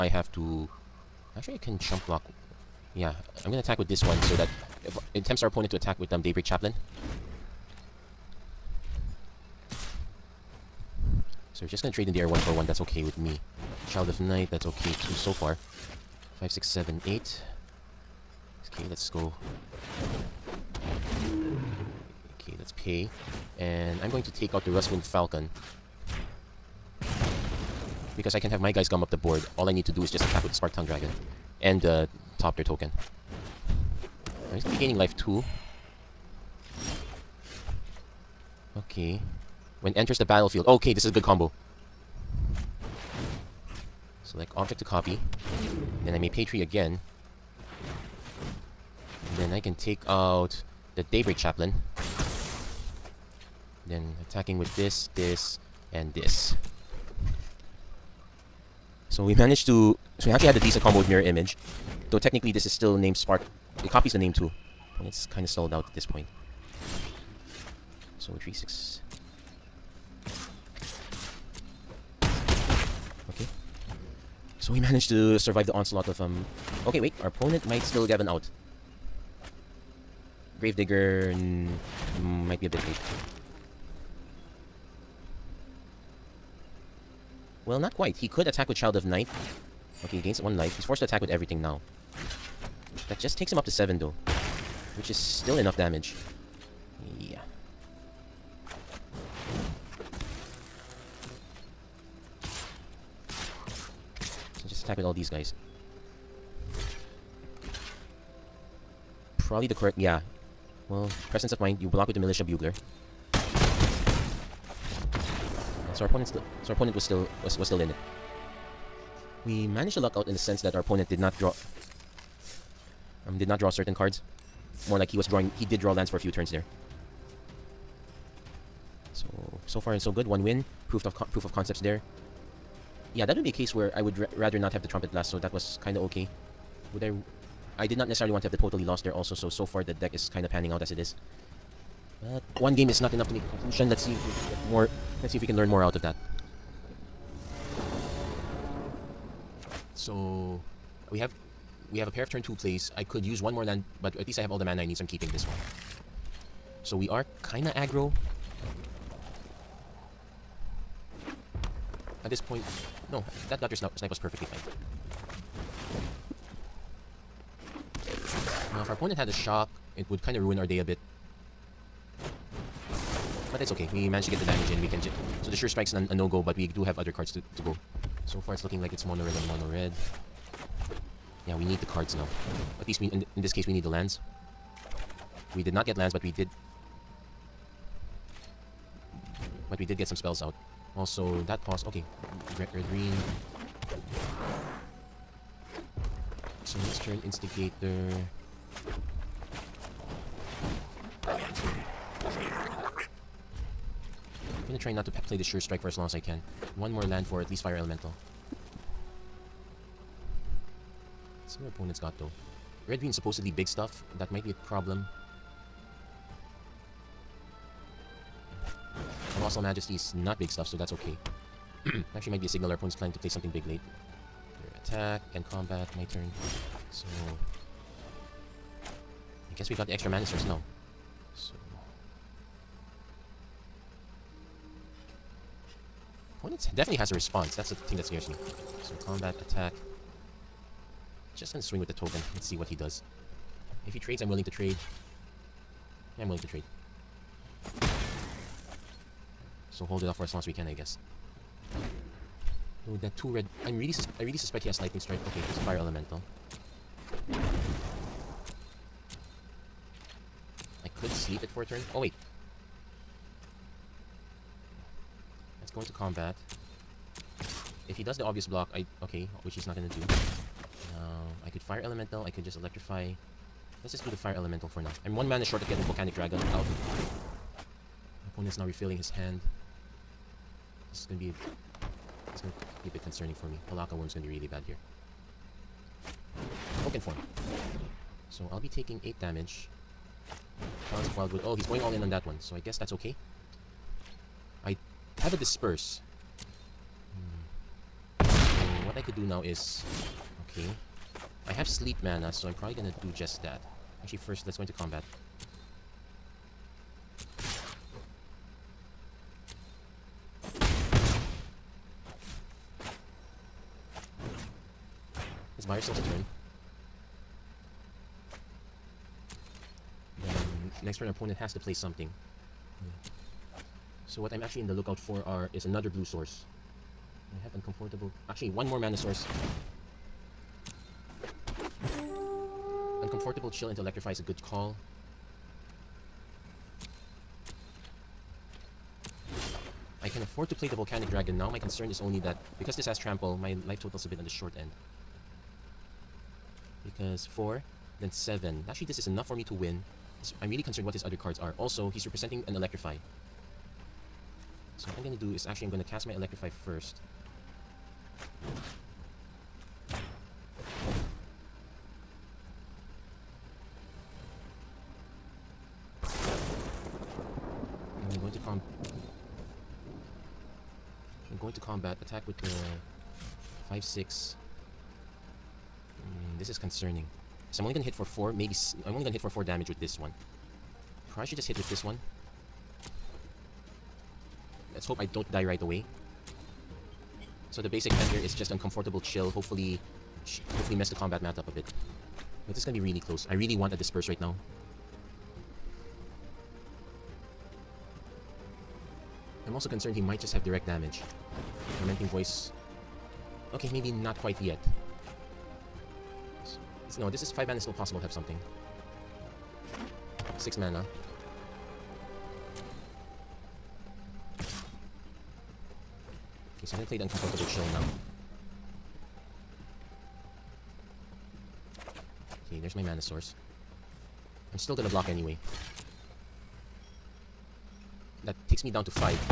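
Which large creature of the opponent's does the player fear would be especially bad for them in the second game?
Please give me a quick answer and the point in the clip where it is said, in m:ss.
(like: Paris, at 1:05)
Pelakka Wurm, at 4:43.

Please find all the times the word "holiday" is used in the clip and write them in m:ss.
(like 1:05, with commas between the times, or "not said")
not said.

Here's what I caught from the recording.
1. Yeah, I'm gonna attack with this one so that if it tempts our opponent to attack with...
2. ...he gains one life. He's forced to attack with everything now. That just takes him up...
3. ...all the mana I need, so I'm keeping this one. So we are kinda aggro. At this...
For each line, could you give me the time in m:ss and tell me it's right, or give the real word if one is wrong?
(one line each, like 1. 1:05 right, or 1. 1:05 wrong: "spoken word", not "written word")
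1. 0:02 right
2. 1:30 right
3. 2:34 right.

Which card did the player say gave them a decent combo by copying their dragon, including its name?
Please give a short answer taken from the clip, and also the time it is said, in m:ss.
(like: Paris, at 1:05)
Mirror Image, at 1:01.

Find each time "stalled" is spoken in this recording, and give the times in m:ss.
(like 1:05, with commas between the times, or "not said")
1:05.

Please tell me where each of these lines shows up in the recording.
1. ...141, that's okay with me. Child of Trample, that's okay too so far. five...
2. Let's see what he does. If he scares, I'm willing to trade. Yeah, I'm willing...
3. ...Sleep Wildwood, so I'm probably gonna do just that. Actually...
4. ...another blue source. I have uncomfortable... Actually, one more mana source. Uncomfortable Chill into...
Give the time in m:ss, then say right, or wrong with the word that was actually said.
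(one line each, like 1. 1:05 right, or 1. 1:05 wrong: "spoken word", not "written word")
1. 0:12 wrong: "Night", not "Trample"
2. 4:02 wrong: "trades", not "scares"
3. 5:01 wrong: "Mana", not "Wildwood"
4. 5:25 right.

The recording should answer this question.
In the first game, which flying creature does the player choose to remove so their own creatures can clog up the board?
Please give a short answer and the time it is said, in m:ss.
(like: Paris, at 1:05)
Rustwing Falcon, at 0:24.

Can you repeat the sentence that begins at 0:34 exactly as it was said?
Right, he's gonna be gaining life too.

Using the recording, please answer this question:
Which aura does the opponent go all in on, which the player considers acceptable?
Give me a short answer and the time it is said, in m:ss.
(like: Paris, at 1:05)
Talons of Wildwood, at 4:50.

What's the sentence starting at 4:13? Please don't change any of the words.
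I'm really I really suspect he has lightning strike.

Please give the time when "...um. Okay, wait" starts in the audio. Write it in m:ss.
1:16.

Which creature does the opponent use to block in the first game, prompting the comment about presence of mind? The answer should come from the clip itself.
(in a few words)
Militia Bugler.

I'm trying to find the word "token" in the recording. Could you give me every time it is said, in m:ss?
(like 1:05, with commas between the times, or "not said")
0:32, 4:01.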